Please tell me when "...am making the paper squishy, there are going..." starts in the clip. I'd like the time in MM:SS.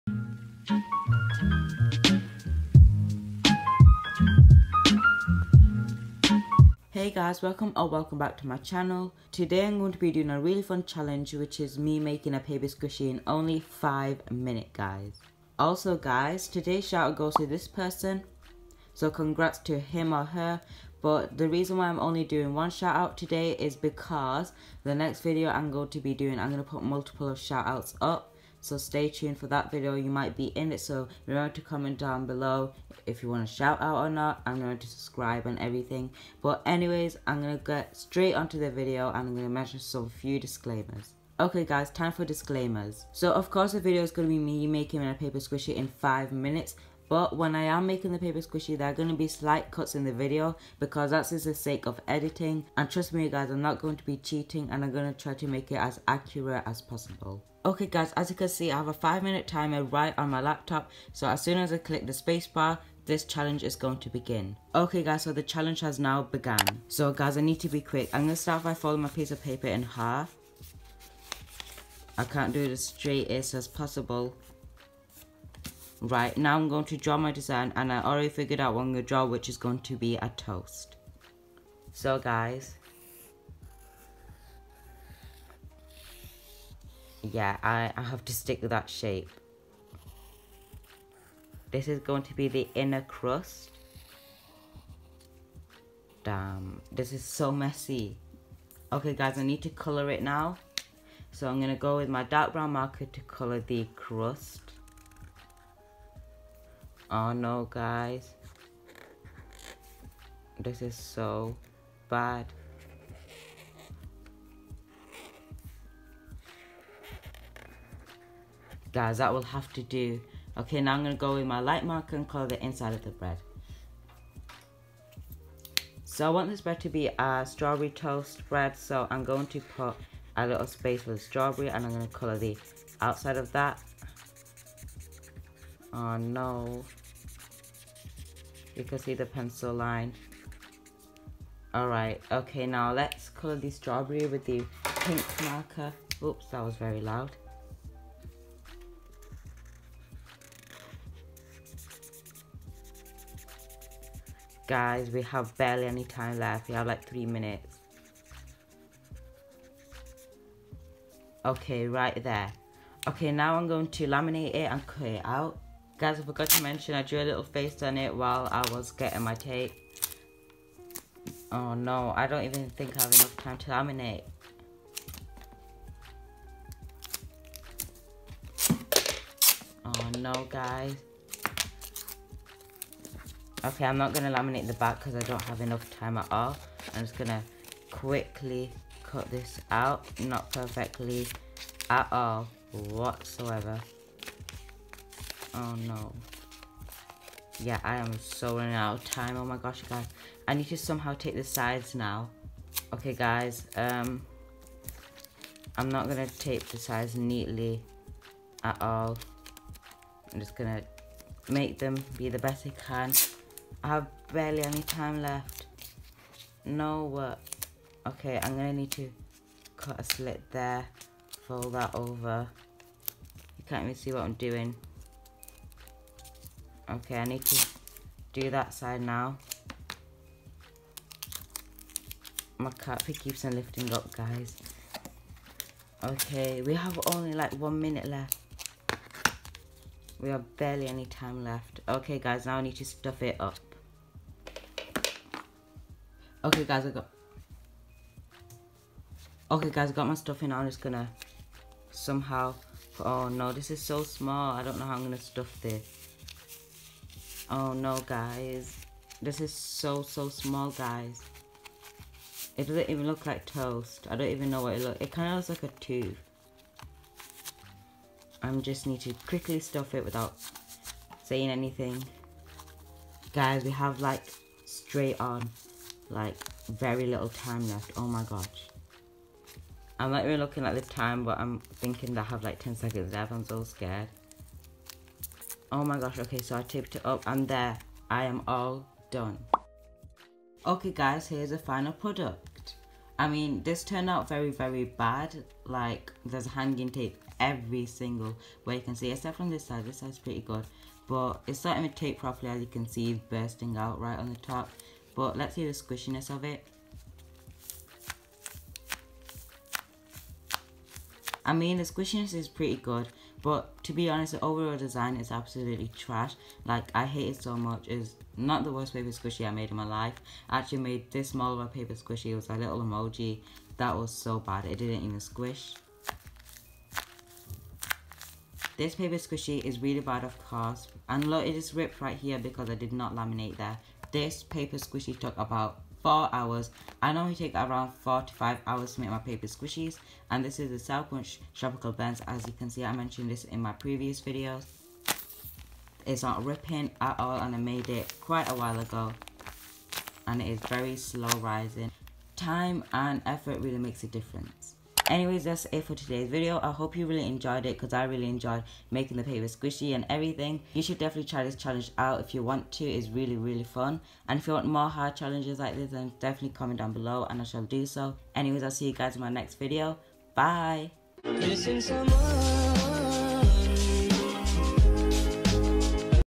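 00:47.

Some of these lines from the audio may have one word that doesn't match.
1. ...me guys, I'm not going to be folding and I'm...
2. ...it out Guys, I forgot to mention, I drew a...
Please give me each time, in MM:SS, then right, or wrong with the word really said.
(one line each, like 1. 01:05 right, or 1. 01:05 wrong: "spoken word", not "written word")
1. 00:53 wrong: "cheating", not "folding"
2. 02:45 right.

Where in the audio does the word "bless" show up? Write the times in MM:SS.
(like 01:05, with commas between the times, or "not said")
not said.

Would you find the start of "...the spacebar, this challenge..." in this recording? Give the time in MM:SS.
01:02.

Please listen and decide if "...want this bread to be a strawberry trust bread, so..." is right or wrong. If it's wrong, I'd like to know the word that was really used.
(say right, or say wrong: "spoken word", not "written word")
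wrong: "toast", not "trust".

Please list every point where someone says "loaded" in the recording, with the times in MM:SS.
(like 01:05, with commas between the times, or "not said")
not said.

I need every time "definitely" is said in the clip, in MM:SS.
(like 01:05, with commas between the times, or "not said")
06:00, 06:06.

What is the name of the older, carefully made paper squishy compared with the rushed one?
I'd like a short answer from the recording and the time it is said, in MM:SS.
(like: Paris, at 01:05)
Sour Punch Tropical Blends, at 05:40.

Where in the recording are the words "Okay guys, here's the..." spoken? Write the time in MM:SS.
04:50.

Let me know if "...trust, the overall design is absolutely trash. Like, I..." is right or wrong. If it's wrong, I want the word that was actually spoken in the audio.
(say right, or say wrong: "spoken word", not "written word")
wrong: "honest", not "trust".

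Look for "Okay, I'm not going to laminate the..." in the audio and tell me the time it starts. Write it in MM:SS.
03:03.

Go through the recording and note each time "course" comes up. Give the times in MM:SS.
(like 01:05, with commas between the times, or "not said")
00:43, 05:30.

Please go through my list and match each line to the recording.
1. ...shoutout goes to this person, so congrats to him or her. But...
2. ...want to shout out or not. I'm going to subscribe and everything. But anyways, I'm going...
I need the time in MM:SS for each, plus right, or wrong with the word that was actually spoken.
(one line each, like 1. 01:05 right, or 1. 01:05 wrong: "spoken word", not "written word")
1. 00:16 right
2. 00:33 right.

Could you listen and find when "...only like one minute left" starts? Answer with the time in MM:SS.
03:57.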